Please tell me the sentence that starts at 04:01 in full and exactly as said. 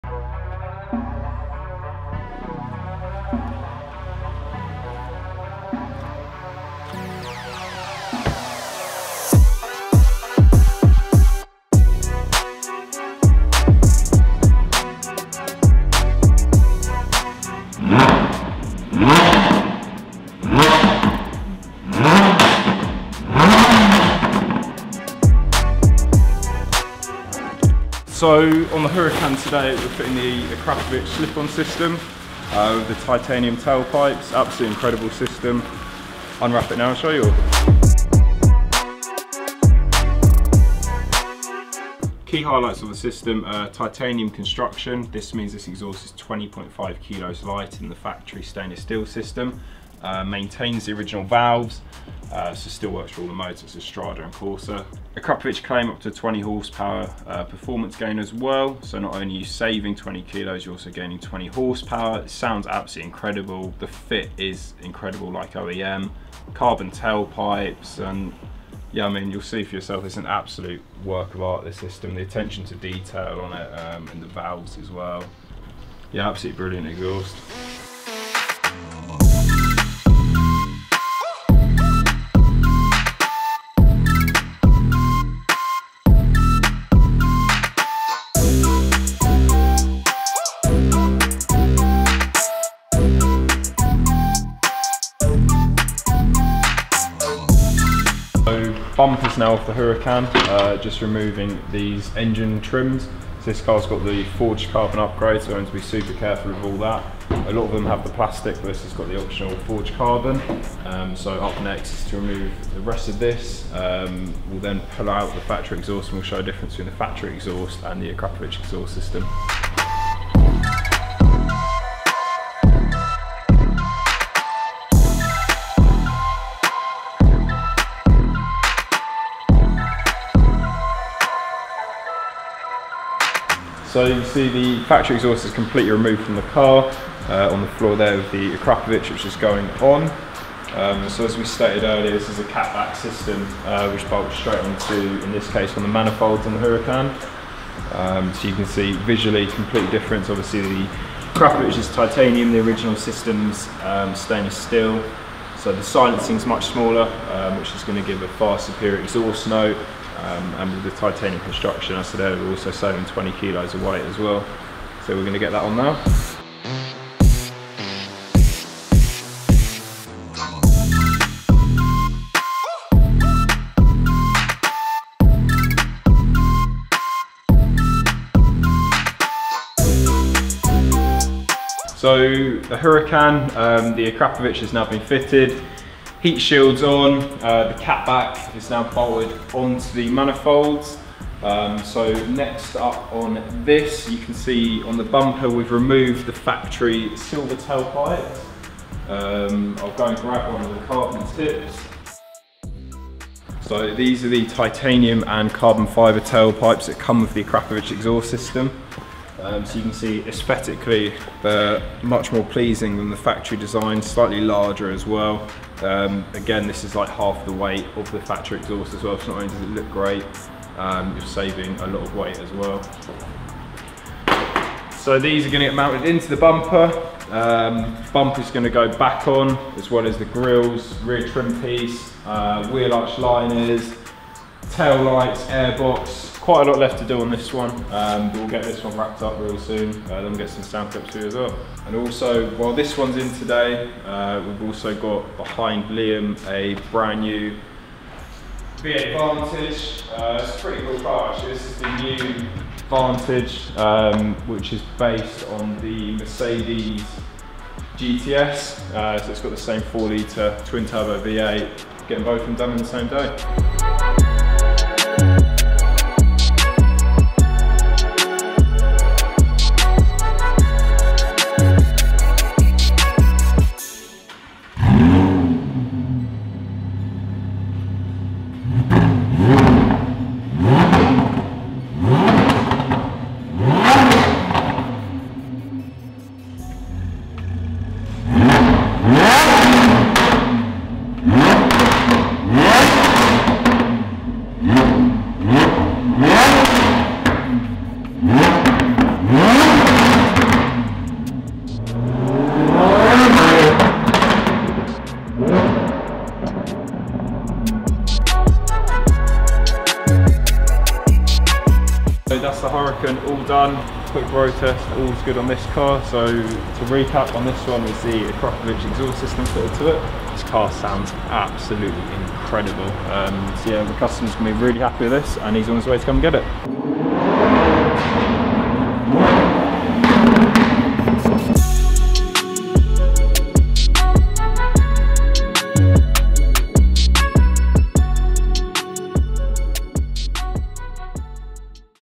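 And also, while this one's in today, uh, we've also got behind Liam a brand new V8 Vantage.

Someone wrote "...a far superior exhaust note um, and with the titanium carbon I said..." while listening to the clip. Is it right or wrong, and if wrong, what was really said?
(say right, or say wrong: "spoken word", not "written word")
wrong: "construction", not "carbon".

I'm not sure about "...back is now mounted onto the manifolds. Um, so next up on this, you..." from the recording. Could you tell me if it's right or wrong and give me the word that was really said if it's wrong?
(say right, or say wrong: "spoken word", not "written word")
wrong: "bolted", not "mounted".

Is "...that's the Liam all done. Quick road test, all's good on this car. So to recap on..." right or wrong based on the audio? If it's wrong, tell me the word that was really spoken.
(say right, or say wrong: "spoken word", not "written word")
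wrong: "Huracan", not "Liam".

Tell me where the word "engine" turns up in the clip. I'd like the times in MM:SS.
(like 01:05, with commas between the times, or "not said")
01:42.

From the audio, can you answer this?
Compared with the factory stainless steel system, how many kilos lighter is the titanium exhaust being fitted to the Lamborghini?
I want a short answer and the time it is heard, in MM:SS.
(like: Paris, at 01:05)
20.5, at 00:46.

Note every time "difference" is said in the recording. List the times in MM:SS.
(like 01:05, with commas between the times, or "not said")
01:56, 02:29.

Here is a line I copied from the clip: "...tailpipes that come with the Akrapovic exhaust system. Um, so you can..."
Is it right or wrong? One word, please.
right.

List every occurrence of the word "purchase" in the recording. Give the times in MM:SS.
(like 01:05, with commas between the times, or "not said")
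not said.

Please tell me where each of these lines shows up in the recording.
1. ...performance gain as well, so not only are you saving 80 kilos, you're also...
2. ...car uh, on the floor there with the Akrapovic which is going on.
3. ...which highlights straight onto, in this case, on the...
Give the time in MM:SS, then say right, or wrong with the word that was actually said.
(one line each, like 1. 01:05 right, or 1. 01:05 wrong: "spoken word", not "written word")
1. 00:57 wrong: "20", not "80"
2. 02:16 right
3. 02:23 wrong: "bolts", not "highlights".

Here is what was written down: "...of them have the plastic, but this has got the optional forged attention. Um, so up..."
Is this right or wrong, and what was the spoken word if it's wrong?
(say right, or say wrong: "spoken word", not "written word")
wrong: "carbon", not "attention".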